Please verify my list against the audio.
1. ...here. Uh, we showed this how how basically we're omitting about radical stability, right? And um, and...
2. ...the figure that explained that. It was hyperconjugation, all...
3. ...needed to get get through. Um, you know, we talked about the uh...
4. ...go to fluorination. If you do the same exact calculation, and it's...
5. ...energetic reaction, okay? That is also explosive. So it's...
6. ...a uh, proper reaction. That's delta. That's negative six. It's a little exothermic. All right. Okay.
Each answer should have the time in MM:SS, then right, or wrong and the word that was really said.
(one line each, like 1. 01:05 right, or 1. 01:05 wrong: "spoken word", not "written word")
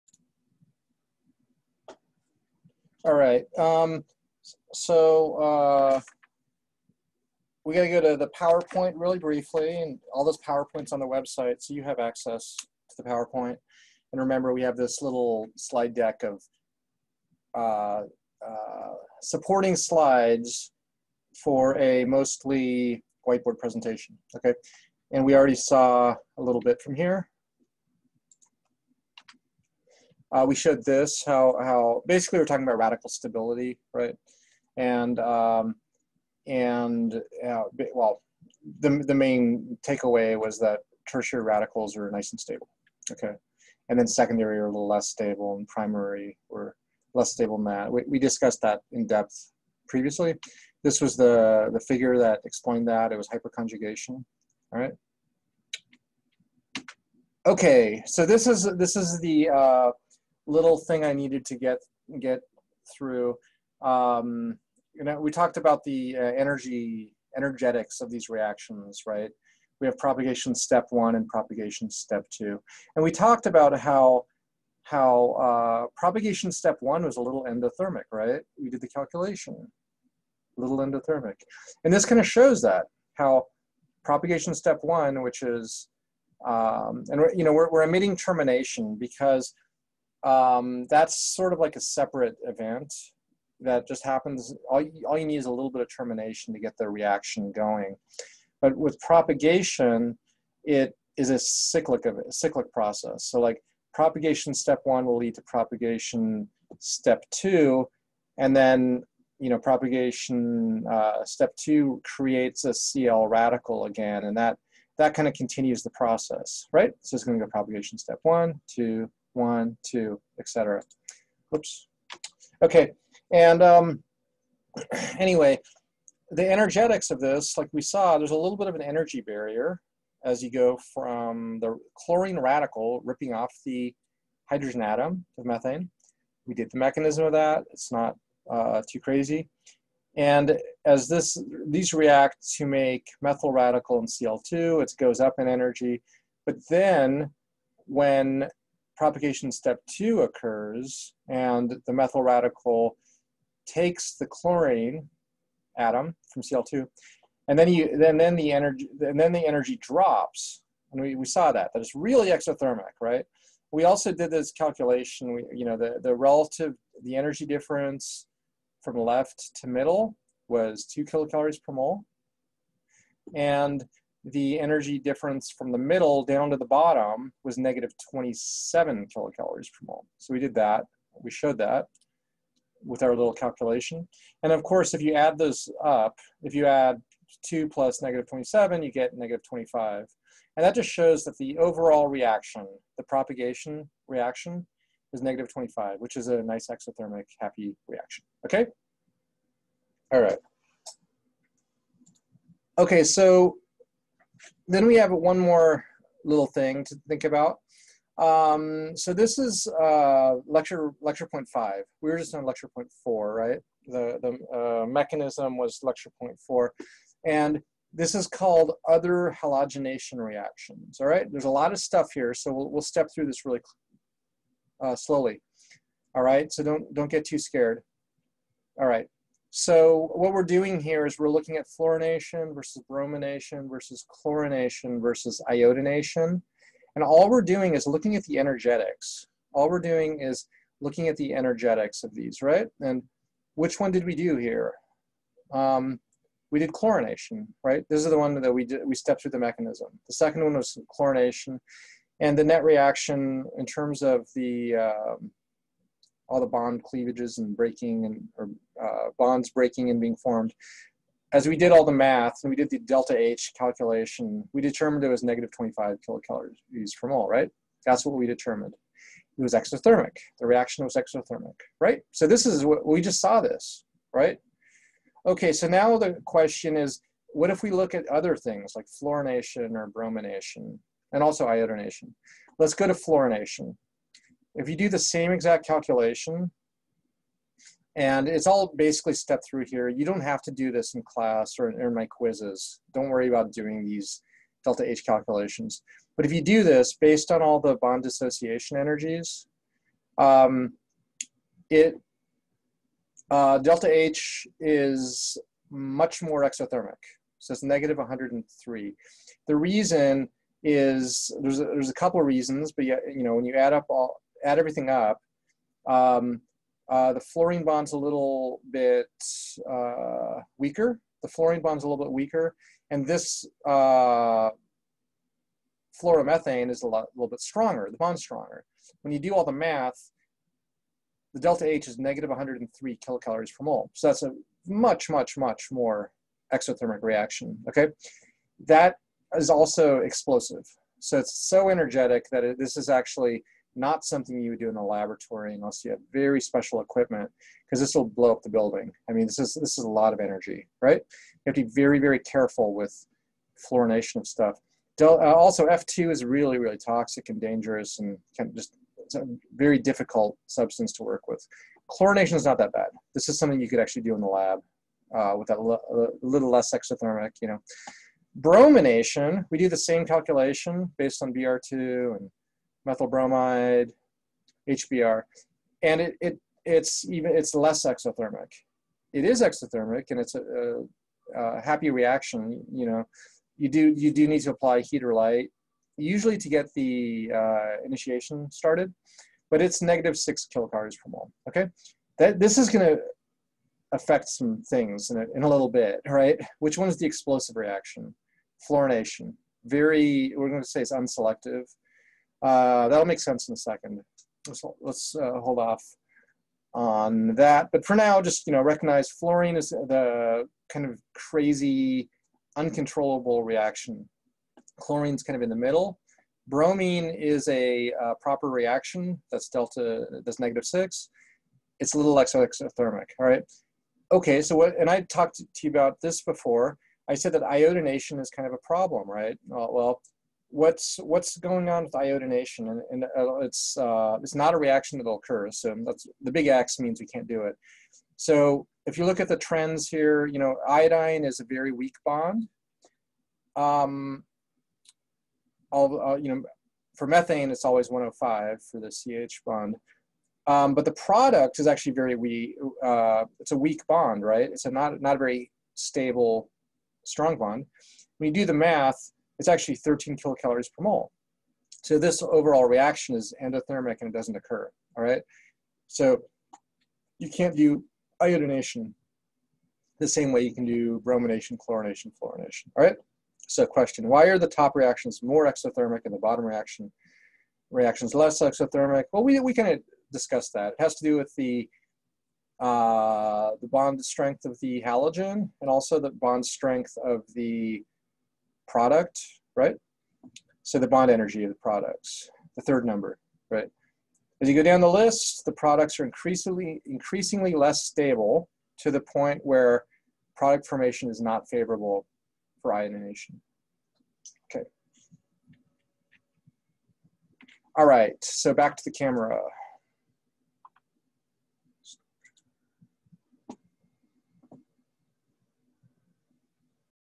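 1. 00:26 wrong: "talking", not "omitting"
2. 00:51 right
3. 01:01 right
4. 04:42 right
5. 05:36 wrong: "exothermic", not "energetic"
6. 06:57 right.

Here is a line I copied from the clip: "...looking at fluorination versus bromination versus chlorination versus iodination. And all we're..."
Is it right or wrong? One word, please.
right.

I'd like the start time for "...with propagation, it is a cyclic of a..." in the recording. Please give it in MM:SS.
01:38.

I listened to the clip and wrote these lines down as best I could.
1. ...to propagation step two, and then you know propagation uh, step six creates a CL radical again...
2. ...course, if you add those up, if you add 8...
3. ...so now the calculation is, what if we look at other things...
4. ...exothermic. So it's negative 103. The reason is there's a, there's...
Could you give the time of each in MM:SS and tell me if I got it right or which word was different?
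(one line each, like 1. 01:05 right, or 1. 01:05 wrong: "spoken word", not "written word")
1. 01:45 wrong: "two", not "six"
2. 03:04 wrong: "2", not "8"
3. 04:35 wrong: "question", not "calculation"
4. 05:06 right.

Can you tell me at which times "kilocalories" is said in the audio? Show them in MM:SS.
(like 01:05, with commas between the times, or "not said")
02:51, 02:59, 04:26, 05:32, 06:30, 07:40.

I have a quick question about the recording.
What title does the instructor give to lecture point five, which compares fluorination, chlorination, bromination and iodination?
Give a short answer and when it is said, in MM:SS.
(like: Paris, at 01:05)
Other halogenation reactions, at 03:38.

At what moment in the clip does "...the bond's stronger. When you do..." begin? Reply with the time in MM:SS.
05:27.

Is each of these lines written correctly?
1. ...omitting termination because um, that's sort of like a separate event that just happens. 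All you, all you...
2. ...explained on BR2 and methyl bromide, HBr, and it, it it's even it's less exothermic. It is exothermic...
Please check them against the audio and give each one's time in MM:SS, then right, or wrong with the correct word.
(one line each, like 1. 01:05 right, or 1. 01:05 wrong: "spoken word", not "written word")
1. 01:27 right
2. 06:10 wrong: "based", not "explained".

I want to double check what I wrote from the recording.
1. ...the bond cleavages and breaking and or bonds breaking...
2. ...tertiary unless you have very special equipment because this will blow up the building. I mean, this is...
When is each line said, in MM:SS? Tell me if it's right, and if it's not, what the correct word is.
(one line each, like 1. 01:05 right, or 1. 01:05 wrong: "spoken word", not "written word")
1. 04:16 right
2. 05:44 wrong: "laboratory", not "tertiary".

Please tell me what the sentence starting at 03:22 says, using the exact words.
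Okay, so then we have one more little thing to think about.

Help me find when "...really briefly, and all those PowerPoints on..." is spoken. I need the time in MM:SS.
00:08.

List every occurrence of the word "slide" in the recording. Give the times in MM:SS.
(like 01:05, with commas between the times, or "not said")
00:15, 00:19.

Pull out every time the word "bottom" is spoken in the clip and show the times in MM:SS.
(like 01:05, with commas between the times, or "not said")
02:56, 07:56.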